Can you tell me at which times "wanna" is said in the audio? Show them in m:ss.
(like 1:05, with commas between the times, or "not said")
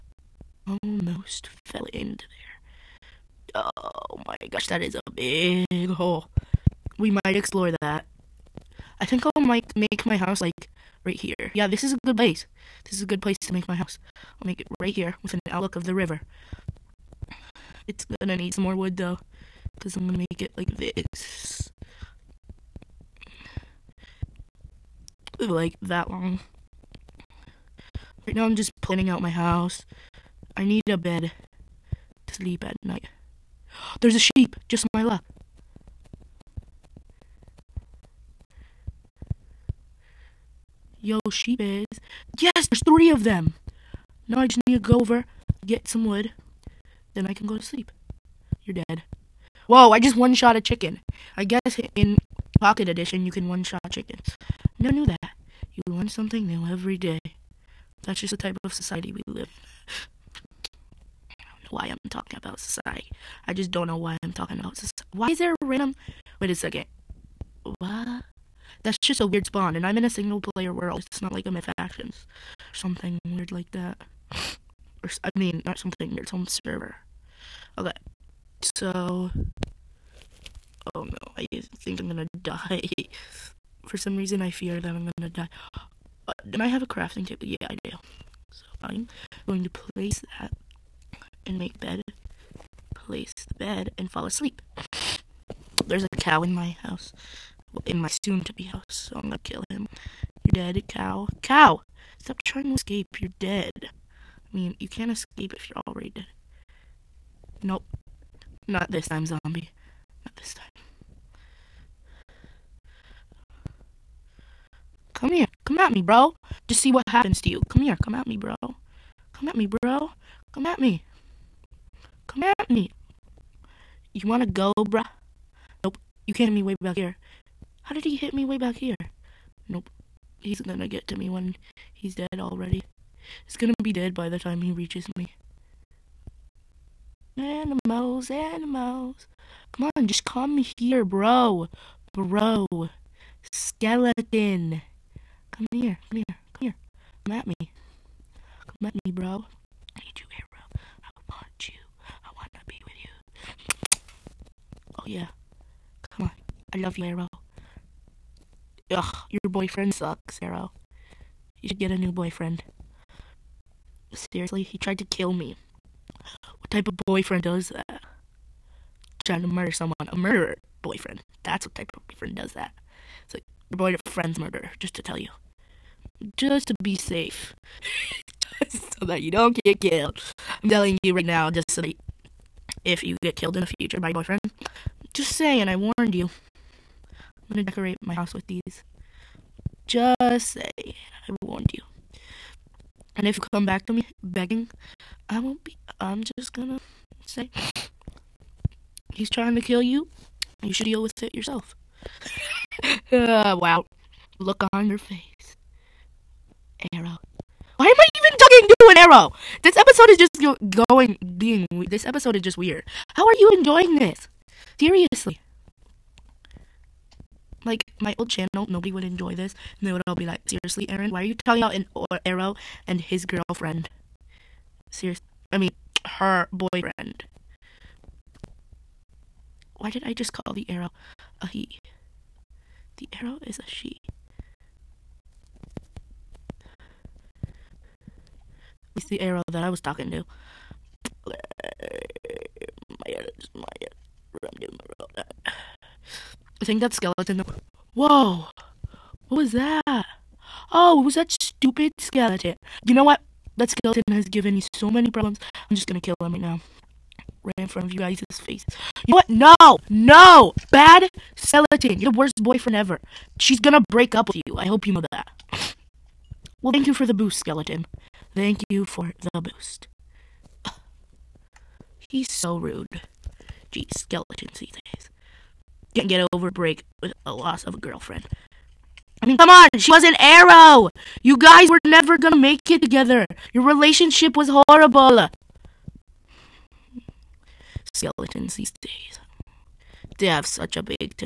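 2:04.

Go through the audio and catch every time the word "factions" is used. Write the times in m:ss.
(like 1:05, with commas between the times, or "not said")
1:11.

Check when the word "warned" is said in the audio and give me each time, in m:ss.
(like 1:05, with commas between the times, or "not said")
3:05, 3:11.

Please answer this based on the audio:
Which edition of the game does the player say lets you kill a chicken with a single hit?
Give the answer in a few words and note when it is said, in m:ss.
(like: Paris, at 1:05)
Pocket Edition, at 0:52.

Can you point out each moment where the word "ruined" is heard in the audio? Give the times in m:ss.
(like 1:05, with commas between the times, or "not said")
not said.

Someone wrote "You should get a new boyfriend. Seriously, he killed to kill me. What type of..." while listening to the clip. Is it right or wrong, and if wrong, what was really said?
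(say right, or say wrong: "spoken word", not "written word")
wrong: "tried", not "killed".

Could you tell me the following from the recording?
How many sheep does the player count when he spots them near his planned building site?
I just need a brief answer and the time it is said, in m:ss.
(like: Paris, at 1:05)
3, at 0:42.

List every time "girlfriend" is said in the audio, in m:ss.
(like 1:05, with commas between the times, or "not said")
3:43, 4:37.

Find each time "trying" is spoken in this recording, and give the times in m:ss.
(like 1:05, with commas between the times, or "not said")
1:42, 2:49, 3:19.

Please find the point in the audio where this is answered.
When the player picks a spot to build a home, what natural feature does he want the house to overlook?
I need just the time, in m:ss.
0:15.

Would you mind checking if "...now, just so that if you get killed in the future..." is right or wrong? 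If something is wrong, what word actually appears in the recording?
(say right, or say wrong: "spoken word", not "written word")
right.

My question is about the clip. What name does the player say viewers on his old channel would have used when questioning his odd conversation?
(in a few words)
Aaron.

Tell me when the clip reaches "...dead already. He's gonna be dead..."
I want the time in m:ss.
2:12.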